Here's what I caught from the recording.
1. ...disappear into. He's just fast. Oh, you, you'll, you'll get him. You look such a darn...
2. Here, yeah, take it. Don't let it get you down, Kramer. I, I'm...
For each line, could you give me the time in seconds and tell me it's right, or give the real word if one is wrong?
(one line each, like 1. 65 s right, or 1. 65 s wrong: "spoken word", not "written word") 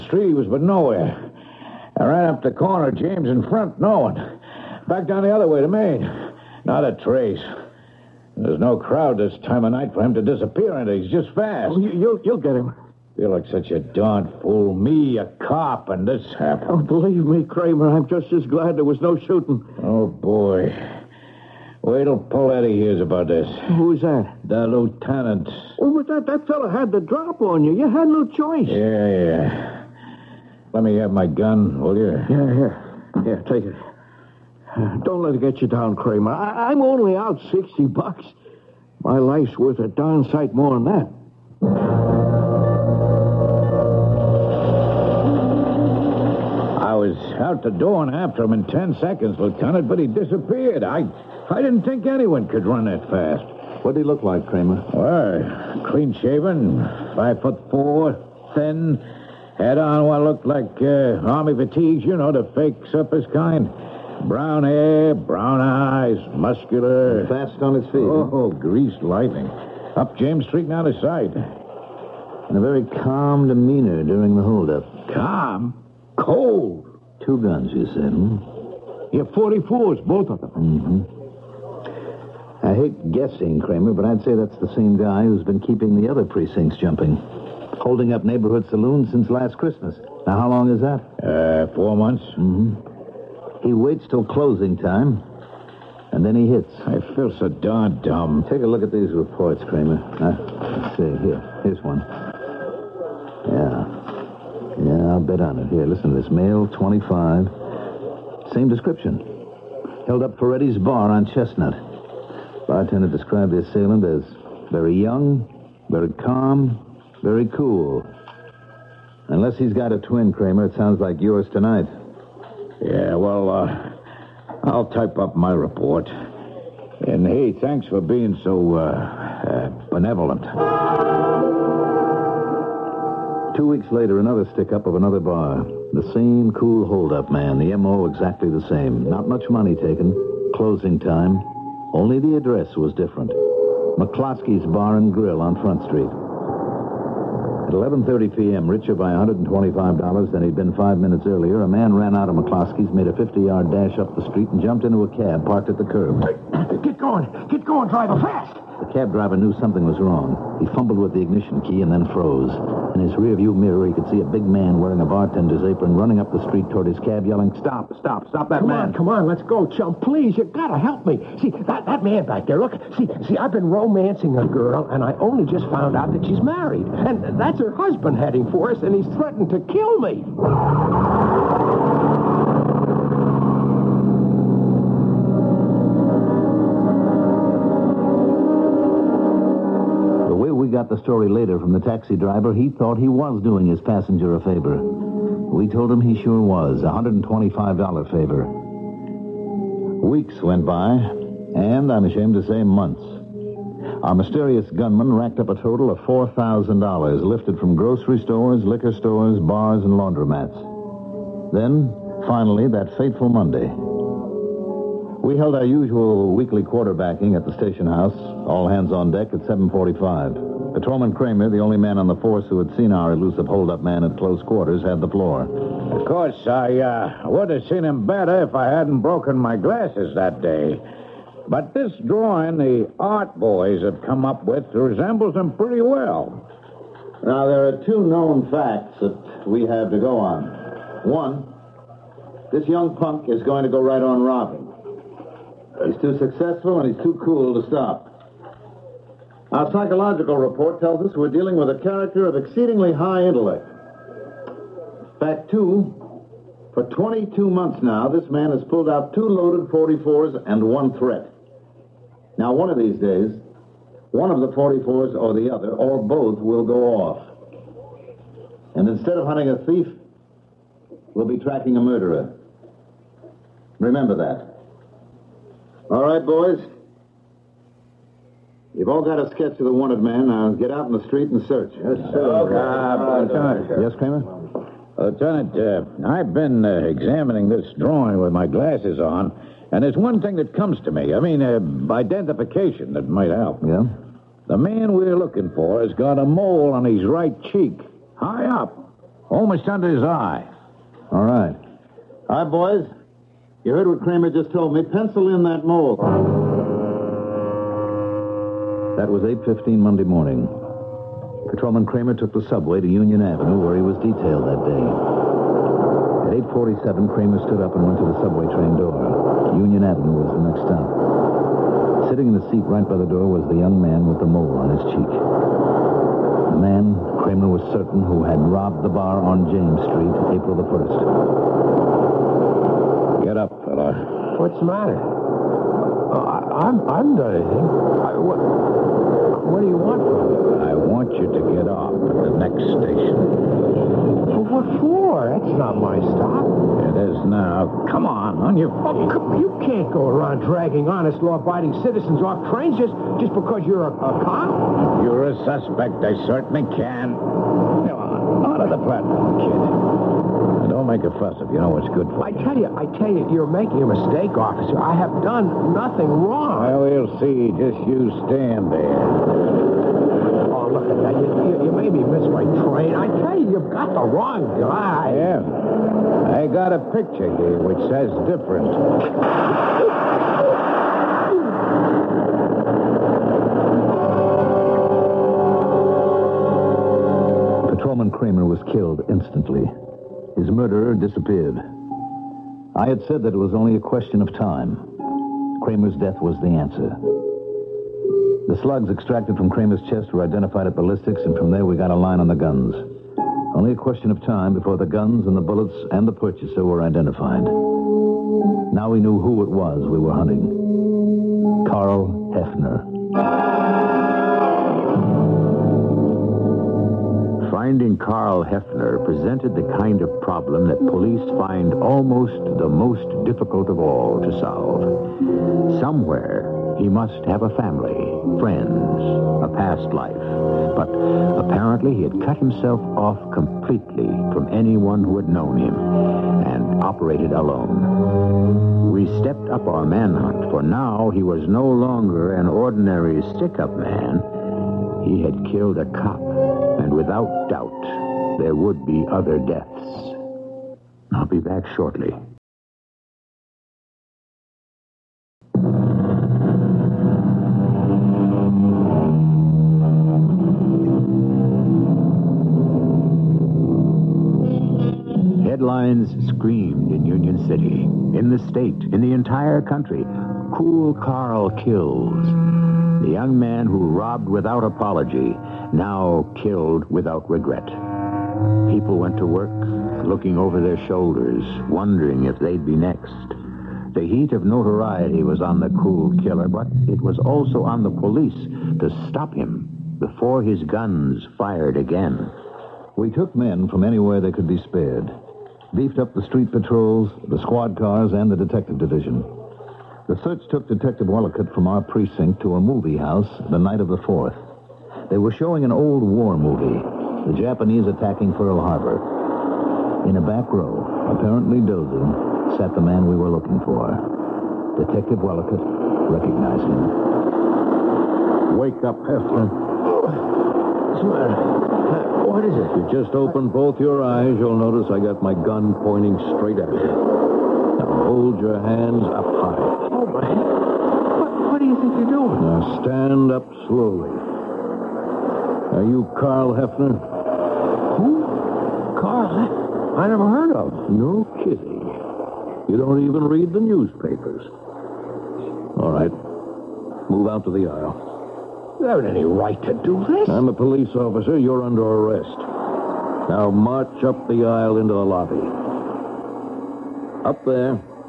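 1. 10 s right
2. 33 s right.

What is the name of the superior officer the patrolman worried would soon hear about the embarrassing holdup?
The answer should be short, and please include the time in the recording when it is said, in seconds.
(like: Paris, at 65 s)
Paletti, at 22 s.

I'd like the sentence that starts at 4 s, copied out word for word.
Back down the other way to Main.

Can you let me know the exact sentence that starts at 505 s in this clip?
They were showing an old war movie, the Japanese attacking Pearl Harbor.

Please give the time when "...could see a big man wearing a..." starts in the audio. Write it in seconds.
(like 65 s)
163 s.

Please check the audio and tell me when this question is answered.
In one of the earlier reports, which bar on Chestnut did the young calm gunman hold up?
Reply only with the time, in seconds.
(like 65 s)
110 s.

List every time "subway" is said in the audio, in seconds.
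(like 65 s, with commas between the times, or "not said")
312 s, 318 s.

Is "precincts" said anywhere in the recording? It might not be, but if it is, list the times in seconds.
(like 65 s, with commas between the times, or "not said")
86 s, 501 s.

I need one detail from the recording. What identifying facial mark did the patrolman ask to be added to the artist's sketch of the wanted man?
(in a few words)
A mole.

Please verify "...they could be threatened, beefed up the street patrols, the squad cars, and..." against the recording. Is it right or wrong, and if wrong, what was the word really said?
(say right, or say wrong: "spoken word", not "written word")
wrong: "spared", not "threatened".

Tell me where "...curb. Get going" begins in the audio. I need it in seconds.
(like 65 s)
155 s.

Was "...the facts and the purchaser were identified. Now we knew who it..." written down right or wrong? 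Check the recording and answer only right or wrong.
wrong.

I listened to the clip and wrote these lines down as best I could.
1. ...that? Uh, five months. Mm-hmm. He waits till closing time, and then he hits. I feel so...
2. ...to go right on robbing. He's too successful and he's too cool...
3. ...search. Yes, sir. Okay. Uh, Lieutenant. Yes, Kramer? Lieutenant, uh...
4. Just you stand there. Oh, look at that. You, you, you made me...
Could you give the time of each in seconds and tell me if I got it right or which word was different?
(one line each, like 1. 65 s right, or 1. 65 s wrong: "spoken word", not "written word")
1. 90 s wrong: "four", not "five"
2. 243 s right
3. 281 s right
4. 367 s right.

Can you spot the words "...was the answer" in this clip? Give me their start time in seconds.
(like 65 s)
396 s.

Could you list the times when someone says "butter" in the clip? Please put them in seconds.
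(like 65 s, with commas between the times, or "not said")
not said.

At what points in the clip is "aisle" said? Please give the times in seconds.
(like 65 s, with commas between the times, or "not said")
547 s, 554 s.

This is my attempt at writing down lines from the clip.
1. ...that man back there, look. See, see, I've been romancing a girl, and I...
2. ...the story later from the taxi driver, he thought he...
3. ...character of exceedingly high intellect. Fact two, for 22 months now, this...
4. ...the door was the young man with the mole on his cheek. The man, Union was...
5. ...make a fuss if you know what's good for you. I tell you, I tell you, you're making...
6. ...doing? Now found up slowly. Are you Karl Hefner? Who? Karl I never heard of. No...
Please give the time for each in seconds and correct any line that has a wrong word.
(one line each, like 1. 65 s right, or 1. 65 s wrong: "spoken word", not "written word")
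1. 171 s right
2. 190 s right
3. 251 s right
4. 322 s wrong: "Kramer", not "Union"
5. 360 s right
6. 532 s wrong: "stand", not "found".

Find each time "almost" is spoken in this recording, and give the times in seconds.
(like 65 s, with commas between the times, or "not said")
299 s, 421 s.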